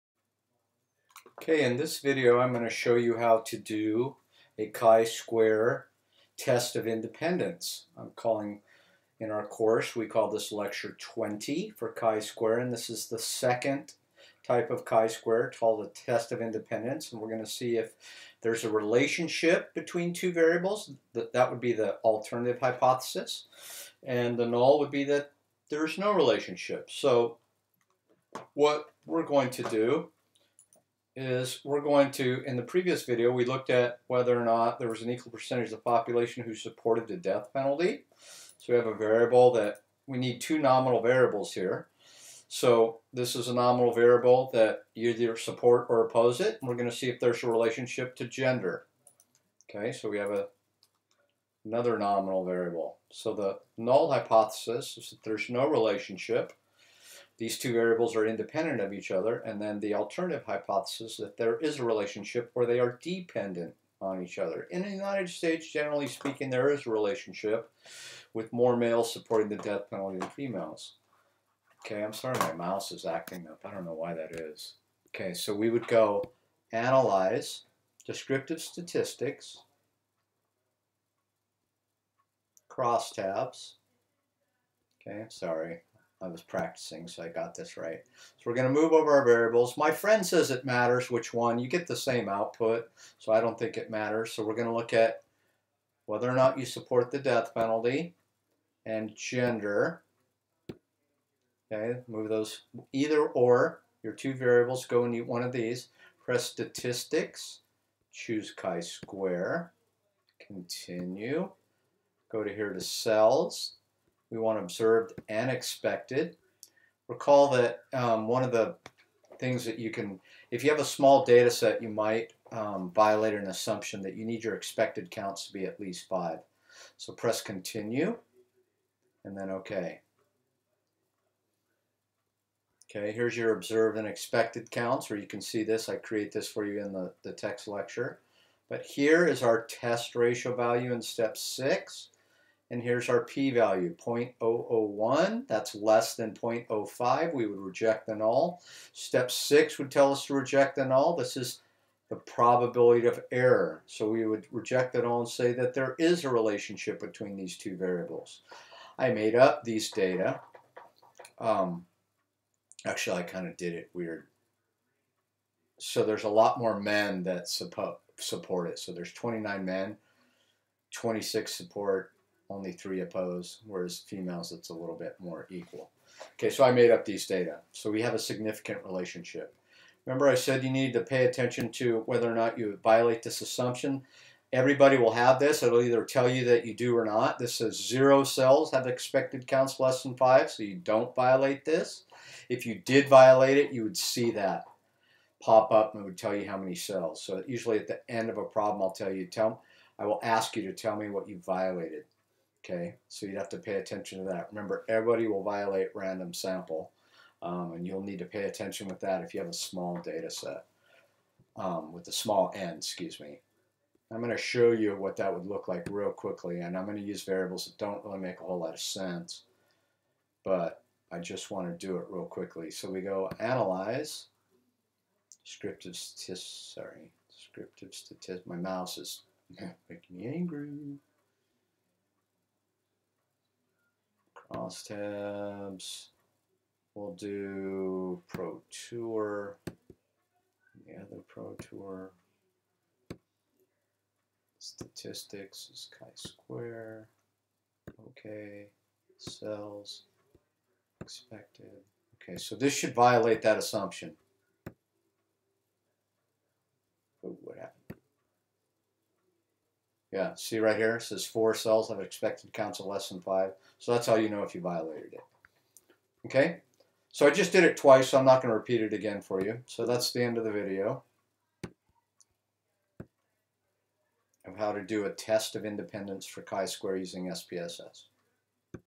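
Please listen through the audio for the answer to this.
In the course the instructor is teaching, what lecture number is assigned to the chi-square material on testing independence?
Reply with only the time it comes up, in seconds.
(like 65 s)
10 s.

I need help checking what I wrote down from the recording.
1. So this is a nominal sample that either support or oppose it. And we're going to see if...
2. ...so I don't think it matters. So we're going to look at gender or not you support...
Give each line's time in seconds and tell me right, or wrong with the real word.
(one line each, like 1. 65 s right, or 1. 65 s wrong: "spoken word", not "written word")
1. 42 s wrong: "variable", not "sample"
2. 93 s wrong: "whether", not "gender".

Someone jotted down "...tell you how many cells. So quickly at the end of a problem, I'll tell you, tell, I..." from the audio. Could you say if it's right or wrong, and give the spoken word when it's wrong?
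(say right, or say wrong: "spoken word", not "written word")
wrong: "usually", not "quickly".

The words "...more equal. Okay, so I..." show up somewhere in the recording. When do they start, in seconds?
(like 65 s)
175 s.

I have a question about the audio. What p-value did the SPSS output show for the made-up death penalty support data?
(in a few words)
0.001.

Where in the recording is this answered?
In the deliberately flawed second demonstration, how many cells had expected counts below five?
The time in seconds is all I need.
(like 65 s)
261 s.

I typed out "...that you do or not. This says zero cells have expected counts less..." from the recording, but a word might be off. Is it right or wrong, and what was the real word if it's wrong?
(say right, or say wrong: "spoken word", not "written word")
right.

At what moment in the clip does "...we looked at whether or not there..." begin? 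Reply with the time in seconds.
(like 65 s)
33 s.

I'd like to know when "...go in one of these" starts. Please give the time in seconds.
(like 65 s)
104 s.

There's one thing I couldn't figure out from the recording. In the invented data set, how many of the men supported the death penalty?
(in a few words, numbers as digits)
26.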